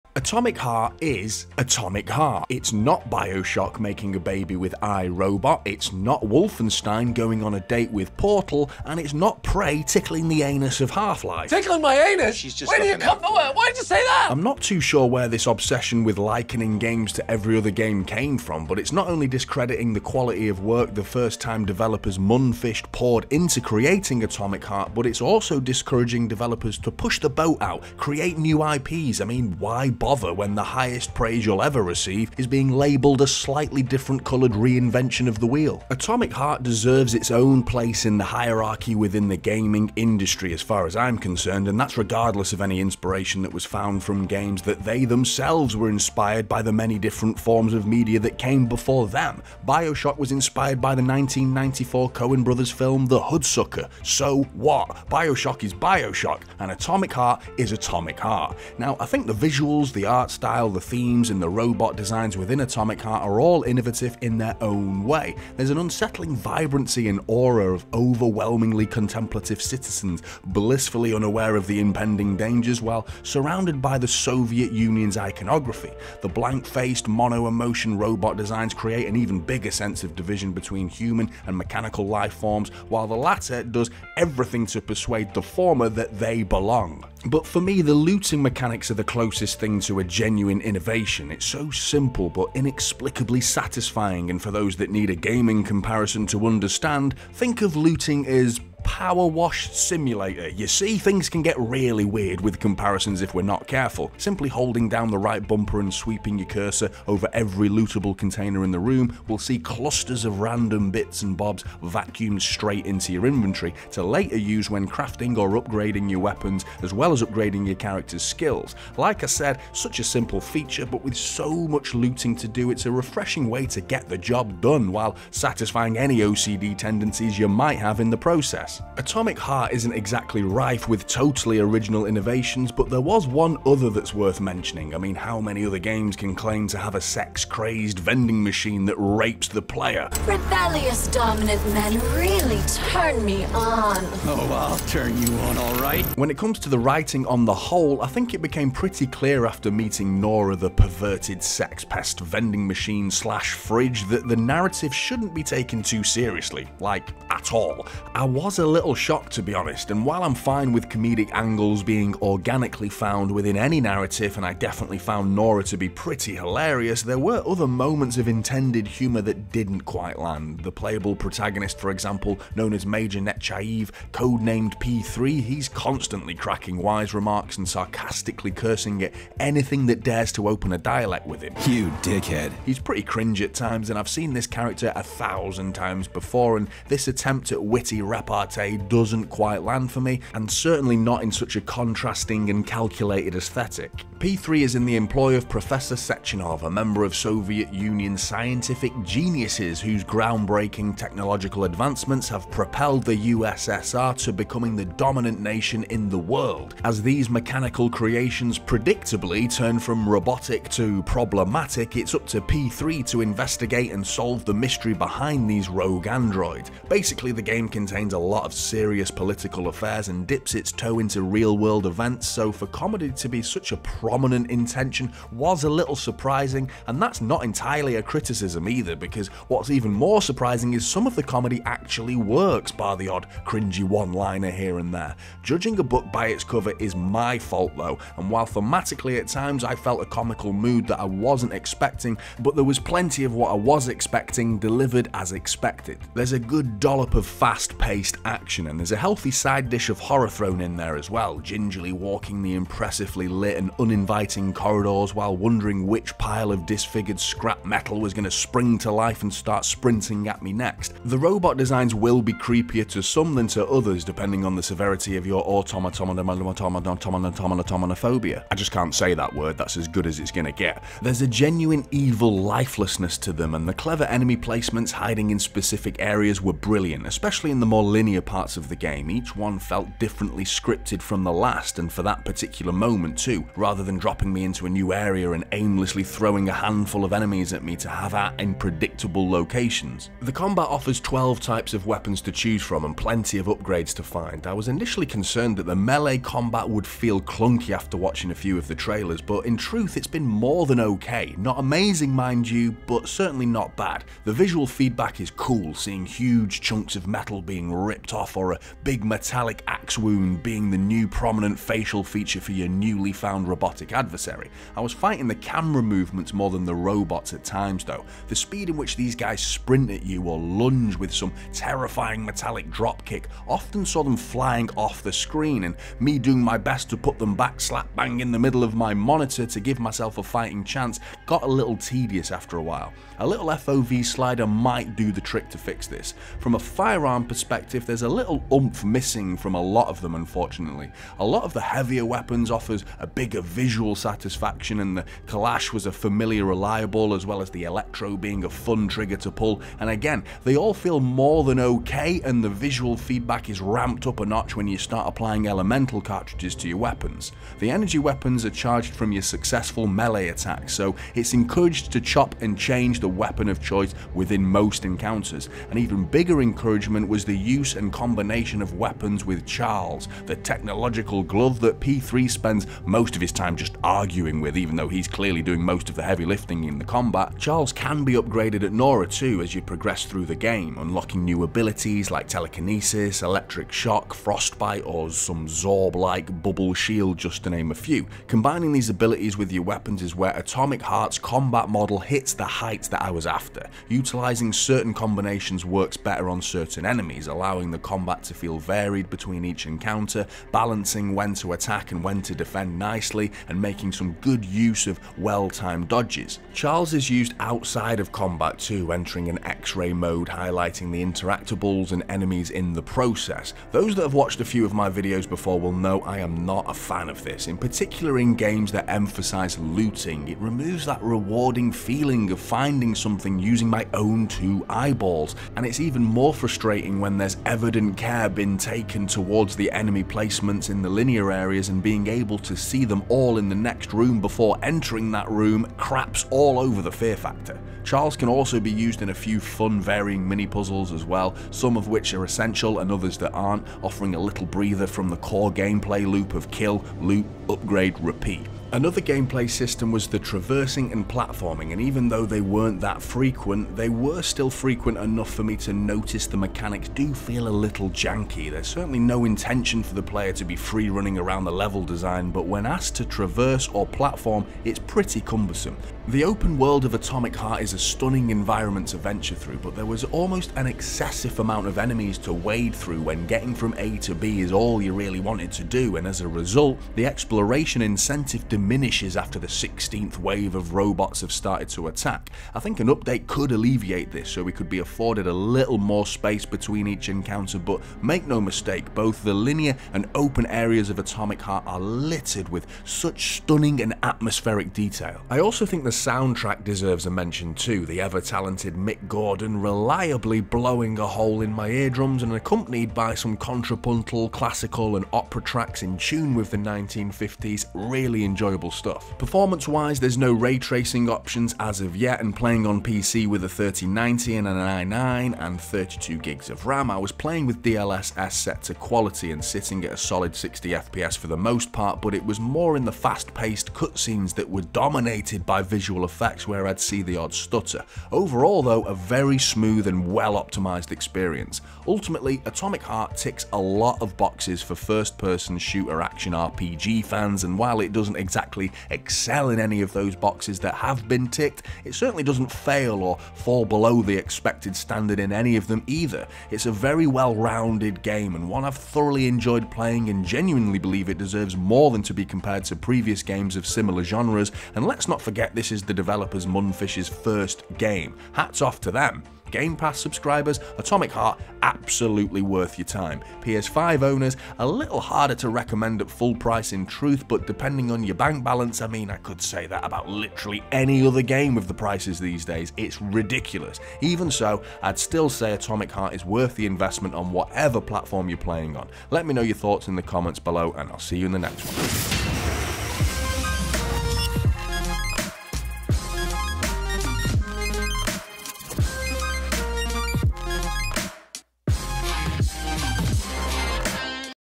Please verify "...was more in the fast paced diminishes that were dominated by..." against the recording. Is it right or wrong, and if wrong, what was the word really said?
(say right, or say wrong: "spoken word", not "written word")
wrong: "cutscenes", not "diminishes".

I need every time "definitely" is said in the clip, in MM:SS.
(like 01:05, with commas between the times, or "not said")
02:44.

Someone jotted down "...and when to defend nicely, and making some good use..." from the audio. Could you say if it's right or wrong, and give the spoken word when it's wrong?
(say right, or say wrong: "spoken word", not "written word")
right.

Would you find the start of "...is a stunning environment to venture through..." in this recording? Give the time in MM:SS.
07:47.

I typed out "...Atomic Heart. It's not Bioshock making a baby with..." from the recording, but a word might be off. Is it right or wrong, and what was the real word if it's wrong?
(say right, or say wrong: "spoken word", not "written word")
right.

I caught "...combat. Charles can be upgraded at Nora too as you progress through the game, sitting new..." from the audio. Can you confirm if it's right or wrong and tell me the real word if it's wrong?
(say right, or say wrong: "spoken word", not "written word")
wrong: "unlocking", not "sitting".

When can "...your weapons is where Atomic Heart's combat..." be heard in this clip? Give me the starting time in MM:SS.
06:29.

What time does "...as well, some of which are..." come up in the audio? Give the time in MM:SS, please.
07:20.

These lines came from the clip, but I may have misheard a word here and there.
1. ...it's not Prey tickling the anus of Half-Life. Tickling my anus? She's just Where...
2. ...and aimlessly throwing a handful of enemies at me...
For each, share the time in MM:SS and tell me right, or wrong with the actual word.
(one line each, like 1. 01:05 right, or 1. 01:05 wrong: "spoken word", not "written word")
1. 00:08 right
2. 04:45 right.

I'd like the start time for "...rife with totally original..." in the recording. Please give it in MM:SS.
02:10.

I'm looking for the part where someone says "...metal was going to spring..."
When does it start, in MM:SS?
04:17.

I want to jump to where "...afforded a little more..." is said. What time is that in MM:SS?
08:04.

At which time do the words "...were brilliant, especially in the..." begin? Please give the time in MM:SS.
04:36.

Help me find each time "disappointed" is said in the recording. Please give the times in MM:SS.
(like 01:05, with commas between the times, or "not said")
not said.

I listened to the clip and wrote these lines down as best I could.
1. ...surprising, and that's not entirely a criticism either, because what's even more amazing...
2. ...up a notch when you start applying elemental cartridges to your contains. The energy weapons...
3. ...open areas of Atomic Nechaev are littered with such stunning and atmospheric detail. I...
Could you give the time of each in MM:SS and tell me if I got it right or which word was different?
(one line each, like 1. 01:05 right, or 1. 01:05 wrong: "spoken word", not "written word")
1. 03:45 wrong: "surprising", not "amazing"
2. 05:54 wrong: "weapons", not "contains"
3. 08:10 wrong: "Heart", not "Nechaev".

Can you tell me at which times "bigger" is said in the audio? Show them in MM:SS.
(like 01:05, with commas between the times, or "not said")
01:19, 05:43, 06:06.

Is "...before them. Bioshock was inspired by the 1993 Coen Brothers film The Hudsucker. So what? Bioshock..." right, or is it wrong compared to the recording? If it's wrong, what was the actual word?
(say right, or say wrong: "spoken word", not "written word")
wrong: "1994", not "1993".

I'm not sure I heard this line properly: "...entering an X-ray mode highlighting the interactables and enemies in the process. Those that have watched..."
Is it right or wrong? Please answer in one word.
right.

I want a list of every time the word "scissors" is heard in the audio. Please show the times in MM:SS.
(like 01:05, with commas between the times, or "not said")
not said.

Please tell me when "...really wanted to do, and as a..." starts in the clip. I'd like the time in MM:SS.
07:54.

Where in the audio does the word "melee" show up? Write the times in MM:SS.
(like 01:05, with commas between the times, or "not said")
04:55, 05:59.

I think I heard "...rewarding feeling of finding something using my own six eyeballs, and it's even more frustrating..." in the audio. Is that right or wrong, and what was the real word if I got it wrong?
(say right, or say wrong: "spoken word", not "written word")
wrong: "two", not "six".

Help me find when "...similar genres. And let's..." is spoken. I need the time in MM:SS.
09:13.